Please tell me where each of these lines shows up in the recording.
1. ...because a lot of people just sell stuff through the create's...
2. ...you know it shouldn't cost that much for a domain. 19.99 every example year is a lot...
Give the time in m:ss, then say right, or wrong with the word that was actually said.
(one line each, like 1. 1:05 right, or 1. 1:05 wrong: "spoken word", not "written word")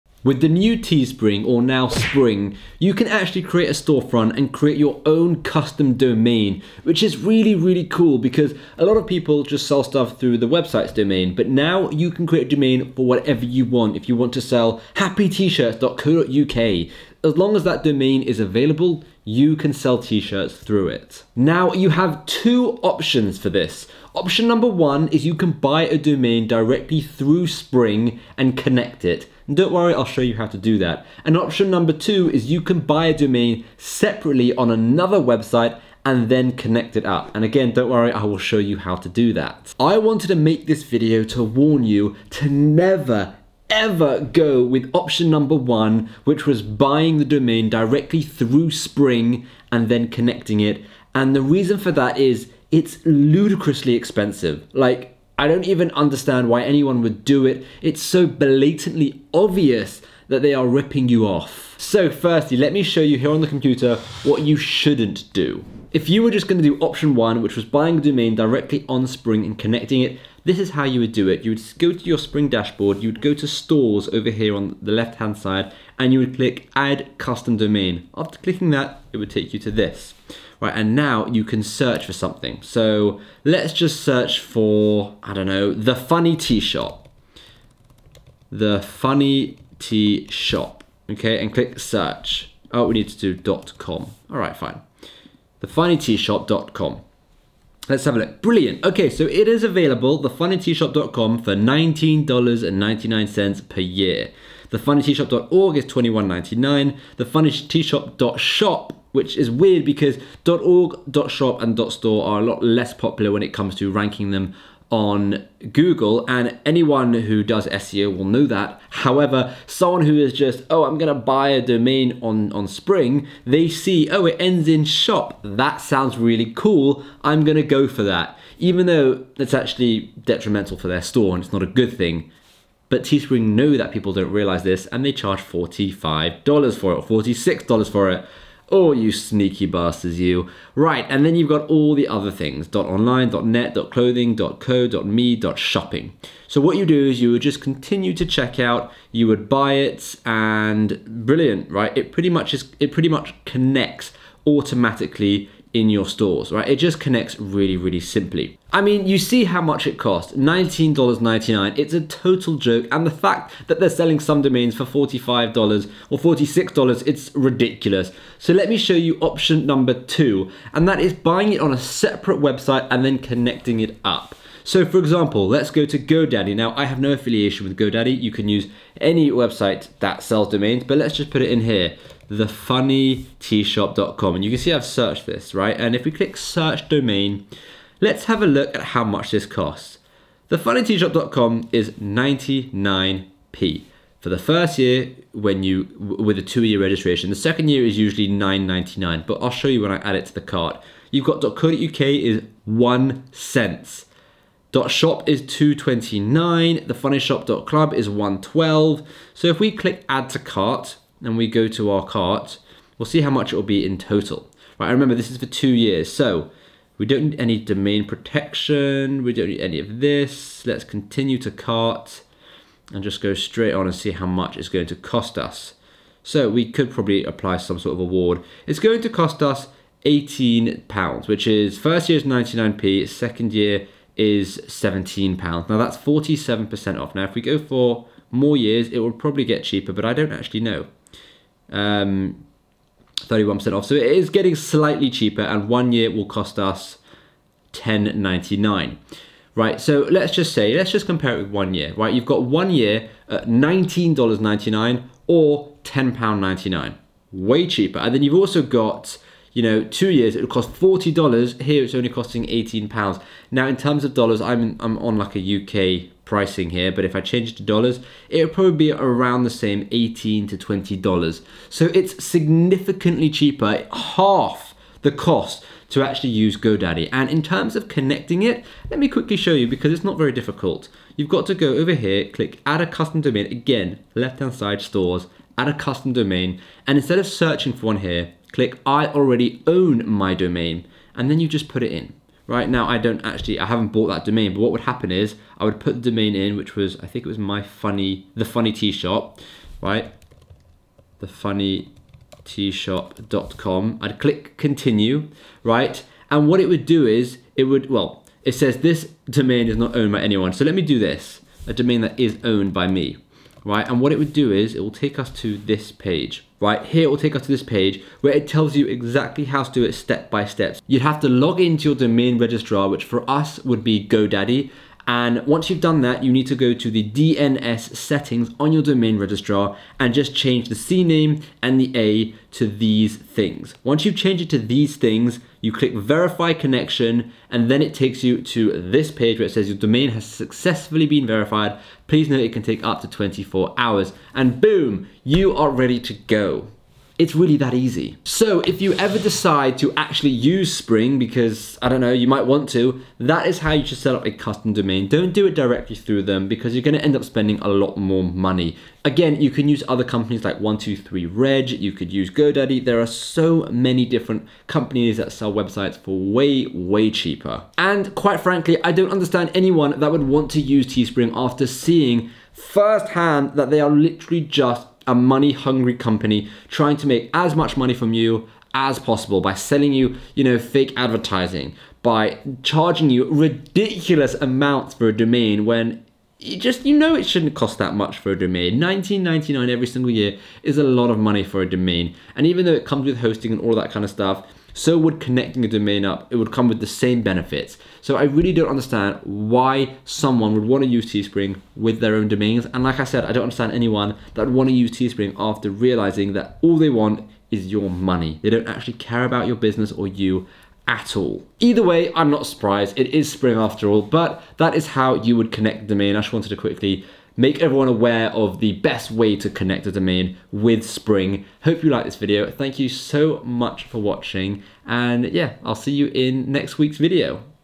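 1. 0:08 wrong: "website", not "create"
2. 6:26 wrong: "single", not "example".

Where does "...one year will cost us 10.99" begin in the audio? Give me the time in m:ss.
4:05.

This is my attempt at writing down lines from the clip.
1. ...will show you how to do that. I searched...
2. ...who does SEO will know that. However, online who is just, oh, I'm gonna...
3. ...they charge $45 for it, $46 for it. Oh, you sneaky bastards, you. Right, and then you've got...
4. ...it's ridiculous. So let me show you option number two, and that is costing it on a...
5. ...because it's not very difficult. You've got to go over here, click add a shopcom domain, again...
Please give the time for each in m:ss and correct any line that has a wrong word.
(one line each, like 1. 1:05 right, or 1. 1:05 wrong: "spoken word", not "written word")
1. 0:38 wrong: "wanted", not "searched"
2. 1:57 wrong: "someone", not "online"
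3. 2:15 right
4. 2:47 wrong: "buying", not "costing"
5. 4:39 wrong: "custom", not "shopcom".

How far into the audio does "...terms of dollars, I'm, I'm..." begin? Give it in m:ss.
4:23.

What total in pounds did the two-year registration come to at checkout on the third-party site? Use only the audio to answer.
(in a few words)
18 pounds.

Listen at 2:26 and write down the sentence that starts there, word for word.
So what you do is you would just continue to check out, you would buy it, and brilliant, right?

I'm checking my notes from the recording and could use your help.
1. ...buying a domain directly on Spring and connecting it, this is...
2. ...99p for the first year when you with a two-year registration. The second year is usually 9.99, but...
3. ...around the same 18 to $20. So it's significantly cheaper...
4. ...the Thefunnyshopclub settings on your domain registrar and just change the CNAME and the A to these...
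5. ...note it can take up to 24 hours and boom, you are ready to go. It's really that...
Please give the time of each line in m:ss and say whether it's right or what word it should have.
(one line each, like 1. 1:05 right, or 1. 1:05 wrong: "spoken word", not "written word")
1. 1:07 right
2. 3:11 right
3. 4:28 right
4. 5:26 wrong: "DNS", not "Thefunnyshopclub"
5. 5:42 right.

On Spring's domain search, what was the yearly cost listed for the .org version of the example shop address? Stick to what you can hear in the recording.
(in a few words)
$21.99.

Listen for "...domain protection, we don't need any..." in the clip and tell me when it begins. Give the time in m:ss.
3:37.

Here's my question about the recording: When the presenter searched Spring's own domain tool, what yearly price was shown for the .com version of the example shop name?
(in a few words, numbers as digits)
$19.99.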